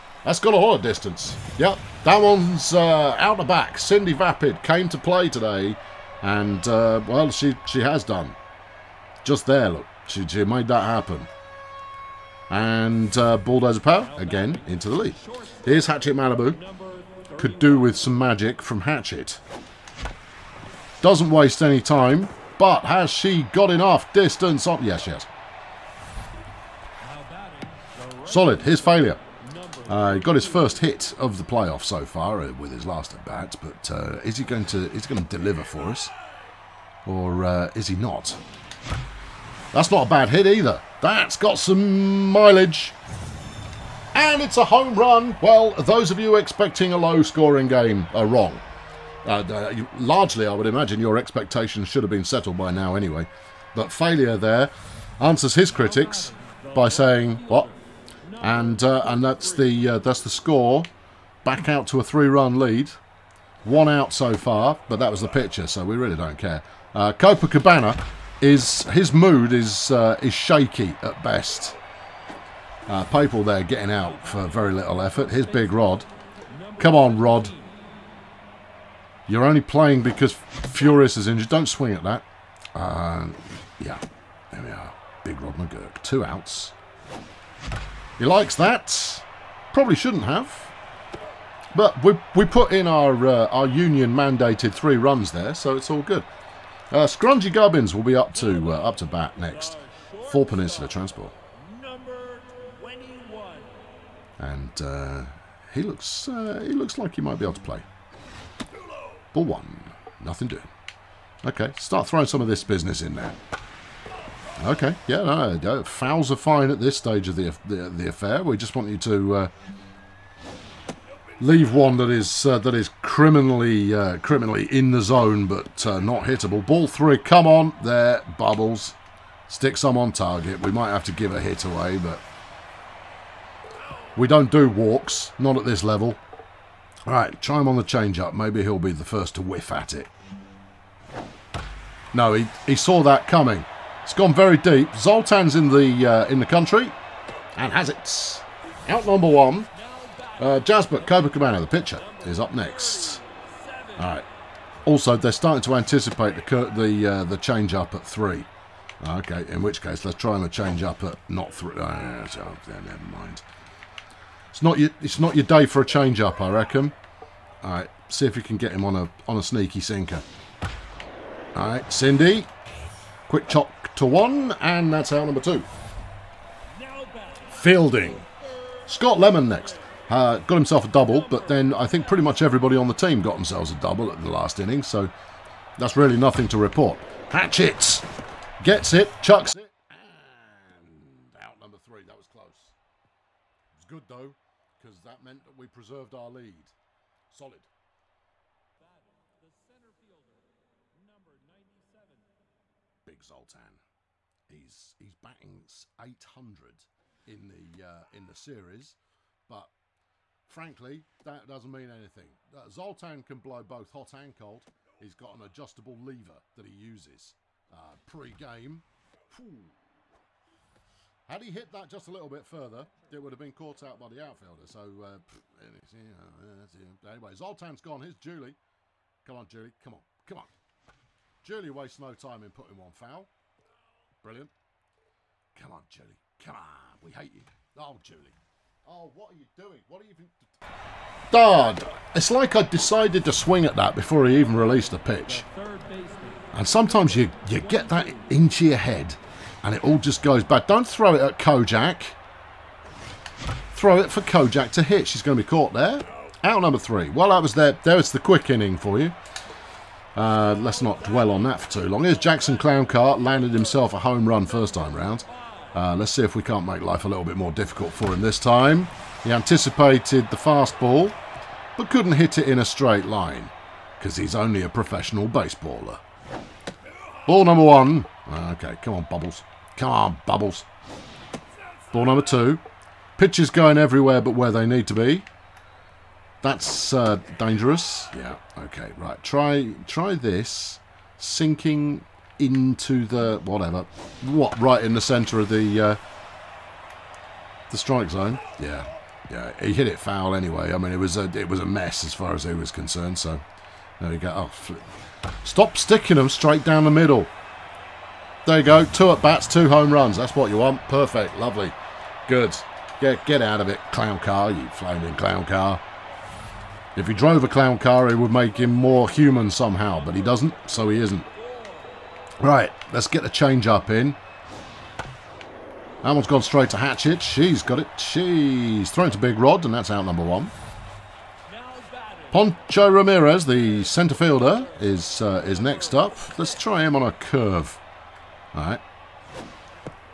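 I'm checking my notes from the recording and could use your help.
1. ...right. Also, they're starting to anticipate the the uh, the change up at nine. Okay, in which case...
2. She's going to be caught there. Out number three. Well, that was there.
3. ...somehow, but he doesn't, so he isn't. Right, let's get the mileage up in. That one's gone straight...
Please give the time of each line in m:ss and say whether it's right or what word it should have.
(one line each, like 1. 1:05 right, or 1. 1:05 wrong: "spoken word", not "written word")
1. 2:34 wrong: "three", not "nine"
2. 4:15 right
3. 5:19 wrong: "change", not "mileage".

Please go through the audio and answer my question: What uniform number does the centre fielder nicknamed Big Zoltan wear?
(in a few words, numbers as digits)
97.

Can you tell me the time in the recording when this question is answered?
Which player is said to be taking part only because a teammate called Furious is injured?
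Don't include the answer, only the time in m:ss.
1:25.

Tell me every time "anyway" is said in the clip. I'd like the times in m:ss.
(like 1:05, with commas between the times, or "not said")
0:52, 3:47, 5:00.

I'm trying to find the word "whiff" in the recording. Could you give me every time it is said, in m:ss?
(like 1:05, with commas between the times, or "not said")
2:19.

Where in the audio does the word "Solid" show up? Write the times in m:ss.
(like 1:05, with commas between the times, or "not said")
0:28, 3:17.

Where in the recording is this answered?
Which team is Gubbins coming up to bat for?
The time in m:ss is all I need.
1:40.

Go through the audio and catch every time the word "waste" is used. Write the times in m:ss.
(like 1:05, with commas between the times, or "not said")
0:21, 3:51.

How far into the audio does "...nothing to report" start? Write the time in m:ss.
3:06.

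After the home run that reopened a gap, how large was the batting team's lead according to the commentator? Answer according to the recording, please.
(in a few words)
3 runs.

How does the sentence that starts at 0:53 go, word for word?
But failure there answers his critics by saying, what?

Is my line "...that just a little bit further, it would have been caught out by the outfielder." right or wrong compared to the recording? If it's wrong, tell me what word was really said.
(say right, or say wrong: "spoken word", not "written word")
right.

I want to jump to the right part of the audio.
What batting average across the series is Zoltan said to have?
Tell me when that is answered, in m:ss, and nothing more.
3:25.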